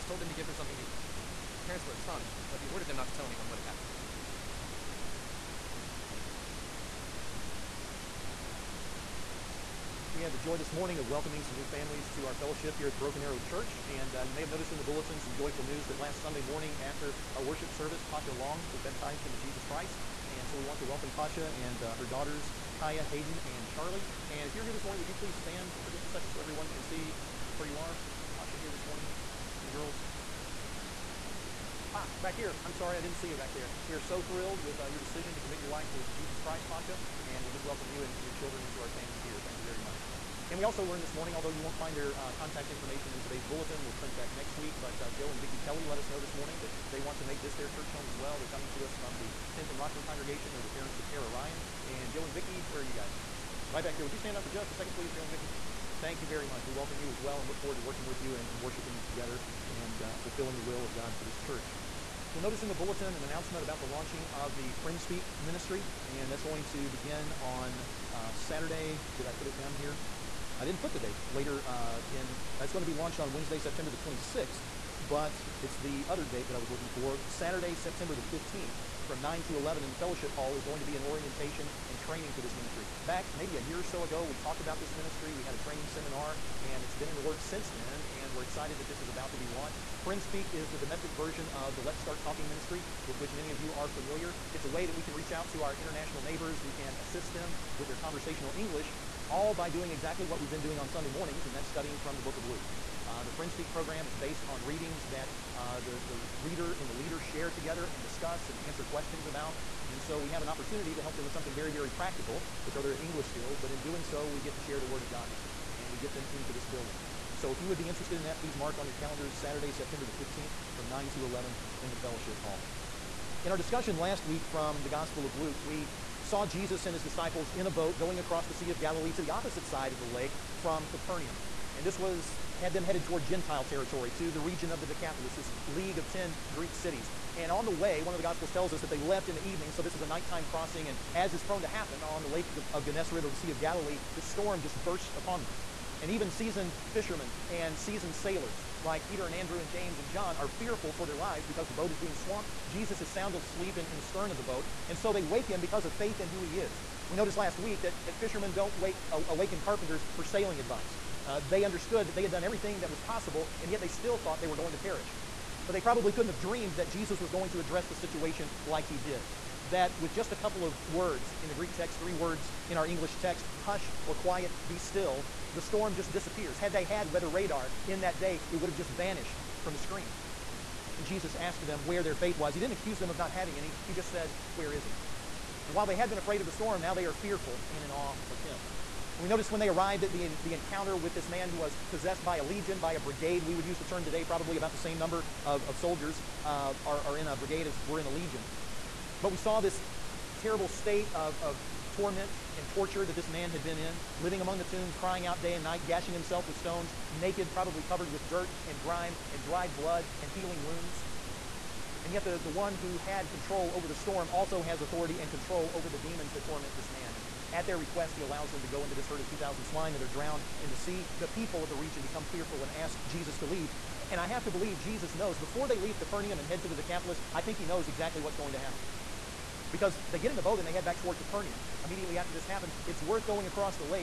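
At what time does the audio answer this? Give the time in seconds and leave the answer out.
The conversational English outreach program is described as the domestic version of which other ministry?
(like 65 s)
91 s.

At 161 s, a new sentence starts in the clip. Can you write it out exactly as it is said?
Uh, they understood that they had done everything that was possible, and yet they still thought they were going to perish.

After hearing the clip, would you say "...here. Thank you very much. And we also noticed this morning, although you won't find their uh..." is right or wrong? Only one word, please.
wrong.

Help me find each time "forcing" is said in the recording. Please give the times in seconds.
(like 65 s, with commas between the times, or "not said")
not said.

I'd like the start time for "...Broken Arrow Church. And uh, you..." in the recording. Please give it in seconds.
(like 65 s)
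12 s.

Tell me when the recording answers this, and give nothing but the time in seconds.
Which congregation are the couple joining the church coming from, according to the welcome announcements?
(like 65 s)
49 s.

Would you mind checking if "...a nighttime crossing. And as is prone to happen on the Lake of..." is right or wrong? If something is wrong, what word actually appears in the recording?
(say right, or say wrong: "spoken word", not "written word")
right.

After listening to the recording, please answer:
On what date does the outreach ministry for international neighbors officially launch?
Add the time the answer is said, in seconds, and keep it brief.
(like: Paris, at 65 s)
Wednesday, September 26, at 73 s.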